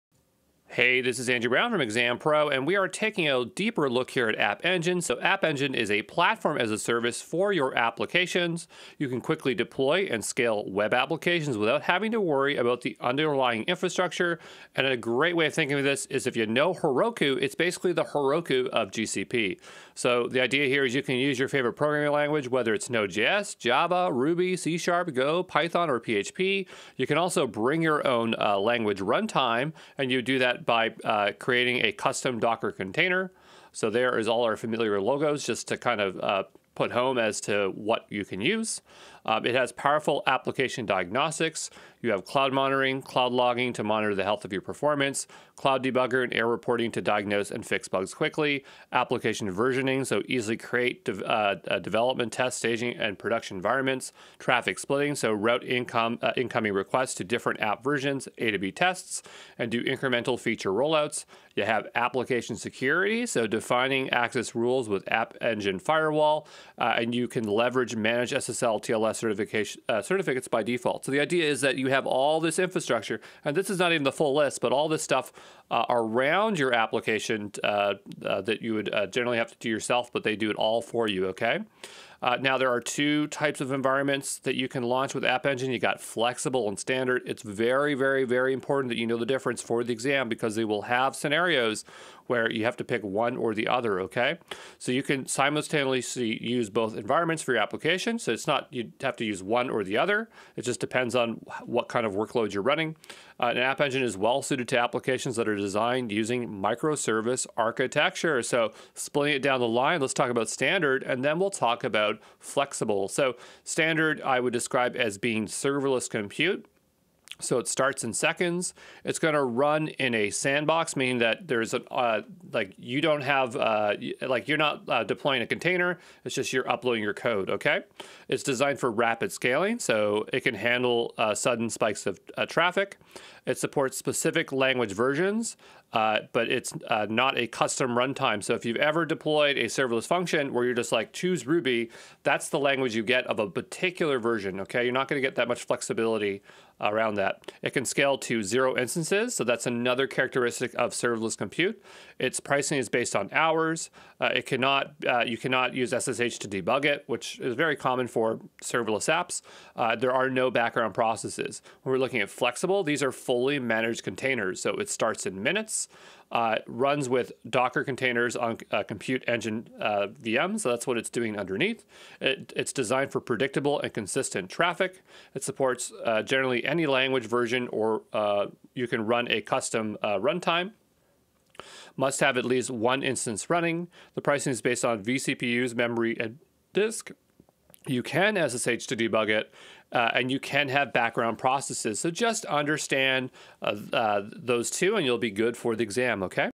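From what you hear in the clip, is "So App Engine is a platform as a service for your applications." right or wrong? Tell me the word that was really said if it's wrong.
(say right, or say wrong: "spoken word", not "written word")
right.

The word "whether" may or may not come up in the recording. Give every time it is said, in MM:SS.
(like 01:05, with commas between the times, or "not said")
00:22.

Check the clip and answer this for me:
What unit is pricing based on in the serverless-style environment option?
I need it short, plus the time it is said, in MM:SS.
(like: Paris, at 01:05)
Hours, at 02:33.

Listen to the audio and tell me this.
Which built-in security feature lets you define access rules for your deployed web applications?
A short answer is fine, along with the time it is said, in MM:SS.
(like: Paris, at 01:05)
App Engine Firewall, at 01:05.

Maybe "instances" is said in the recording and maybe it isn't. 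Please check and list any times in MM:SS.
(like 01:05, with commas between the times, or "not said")
02:28, 03:03.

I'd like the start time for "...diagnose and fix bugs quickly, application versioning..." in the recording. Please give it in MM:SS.
00:47.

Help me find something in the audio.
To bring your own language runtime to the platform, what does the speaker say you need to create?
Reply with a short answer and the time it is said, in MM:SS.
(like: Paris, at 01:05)
A custom Docker container, at 00:31.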